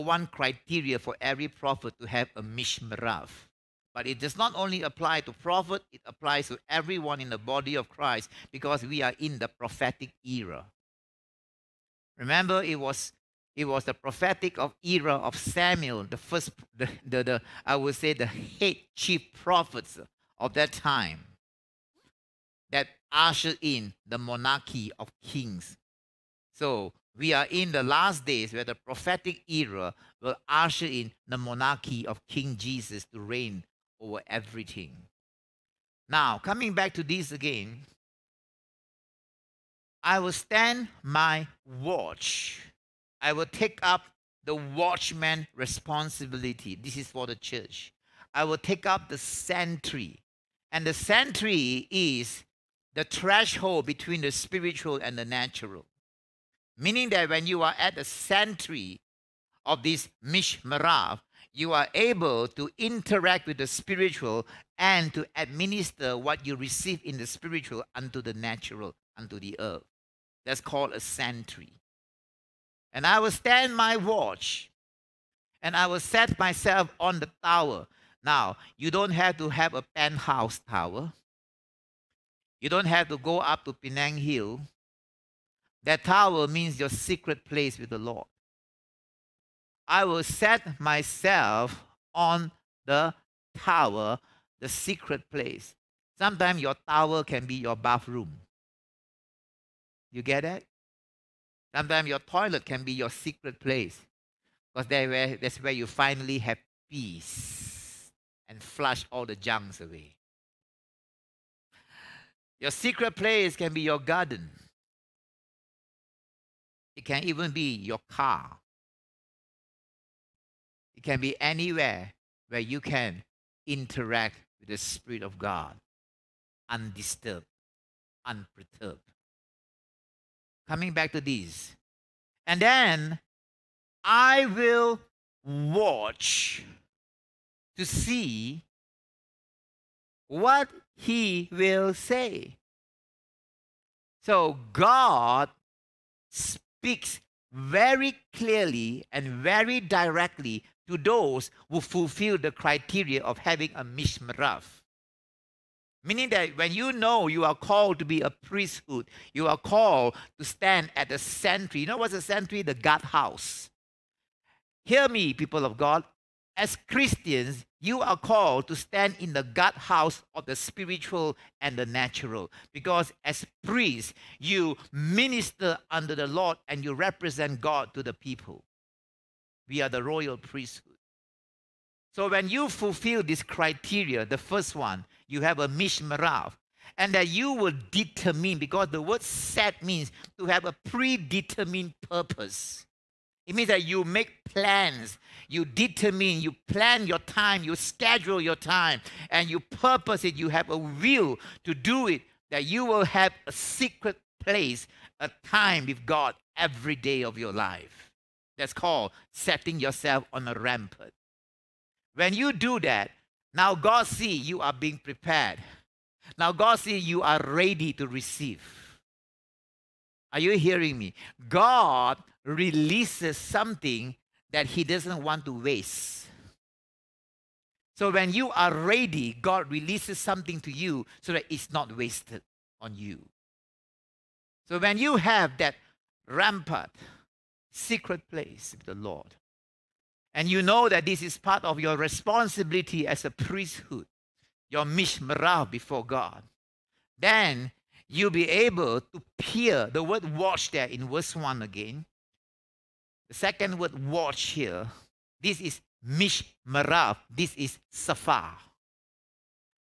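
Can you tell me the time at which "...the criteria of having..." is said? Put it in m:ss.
2:32.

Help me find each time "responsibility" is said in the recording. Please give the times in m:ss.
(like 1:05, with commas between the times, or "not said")
0:45, 4:01.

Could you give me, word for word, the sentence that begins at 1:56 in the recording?
It can even be your car can be anywhere where you can interact with the Spirit of God undisturbed, unperturbed.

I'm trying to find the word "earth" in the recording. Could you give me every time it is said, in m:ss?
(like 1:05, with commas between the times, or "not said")
1:09.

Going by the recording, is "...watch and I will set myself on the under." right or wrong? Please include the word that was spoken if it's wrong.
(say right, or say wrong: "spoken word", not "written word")
wrong: "tower", not "under".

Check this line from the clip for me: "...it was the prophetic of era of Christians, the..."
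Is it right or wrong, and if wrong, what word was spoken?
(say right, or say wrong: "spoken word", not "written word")
wrong: "Samuel", not "Christians".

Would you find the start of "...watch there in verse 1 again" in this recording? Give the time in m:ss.
4:10.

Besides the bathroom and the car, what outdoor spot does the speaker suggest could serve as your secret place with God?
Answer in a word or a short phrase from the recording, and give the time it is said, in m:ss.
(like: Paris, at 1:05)
Your garden, at 1:53.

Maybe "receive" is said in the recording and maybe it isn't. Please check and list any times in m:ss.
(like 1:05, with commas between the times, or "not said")
1:06, 3:38.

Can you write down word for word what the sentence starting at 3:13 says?
It means that you make plans, you determine, you plan your time, you schedule your time, and you purpose it.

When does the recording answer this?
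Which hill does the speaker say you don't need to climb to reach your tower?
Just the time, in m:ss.
1:23.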